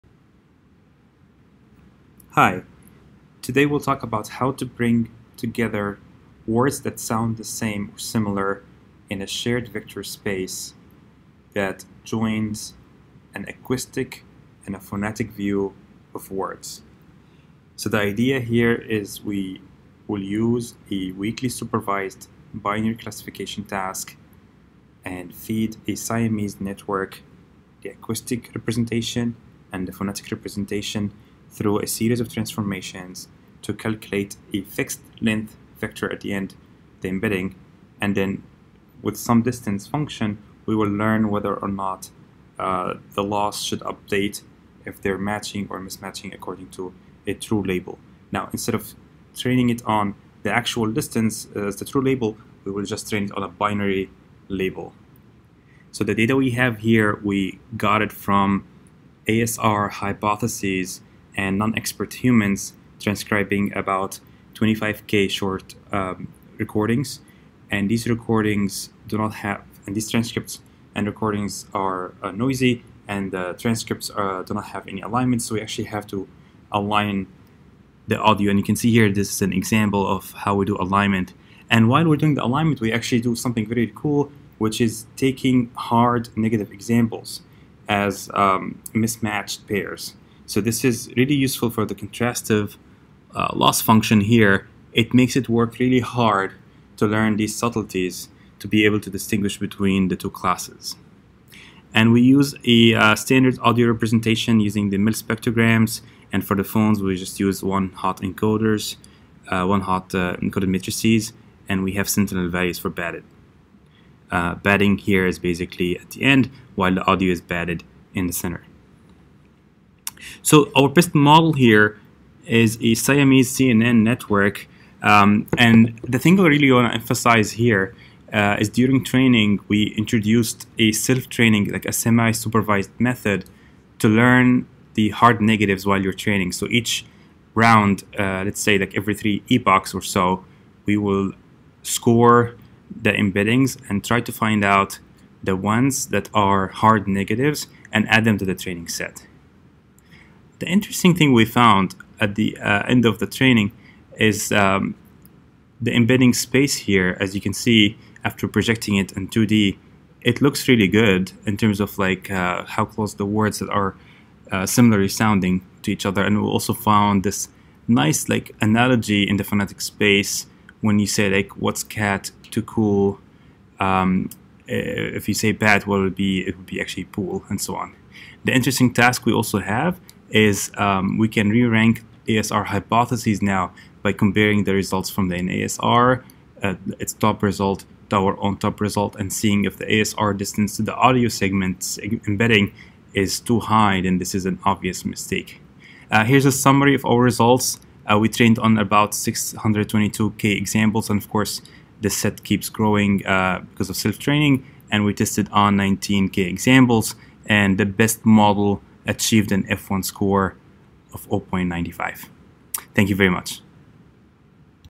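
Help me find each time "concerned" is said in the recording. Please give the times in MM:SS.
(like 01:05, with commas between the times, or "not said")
not said.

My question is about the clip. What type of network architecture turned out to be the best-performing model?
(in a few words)
Siamese CNN.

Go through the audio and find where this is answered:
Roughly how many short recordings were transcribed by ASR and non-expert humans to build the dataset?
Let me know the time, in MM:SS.
01:04.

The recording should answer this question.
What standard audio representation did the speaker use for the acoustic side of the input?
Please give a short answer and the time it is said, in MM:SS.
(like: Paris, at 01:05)
mel spectrograms, at 01:44.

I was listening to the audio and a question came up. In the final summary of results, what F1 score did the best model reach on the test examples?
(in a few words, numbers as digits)
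0.95.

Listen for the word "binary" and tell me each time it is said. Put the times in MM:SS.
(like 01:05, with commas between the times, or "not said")
00:22, 00:53.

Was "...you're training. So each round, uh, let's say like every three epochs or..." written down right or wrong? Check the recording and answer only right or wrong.
right.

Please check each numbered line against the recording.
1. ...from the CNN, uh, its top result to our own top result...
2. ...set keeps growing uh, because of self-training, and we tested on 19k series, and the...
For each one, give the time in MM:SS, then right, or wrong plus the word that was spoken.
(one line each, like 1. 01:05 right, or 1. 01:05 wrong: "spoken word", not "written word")
1. 03:05 wrong: "NASR", not "CNN"
2. 03:22 wrong: "examples", not "series".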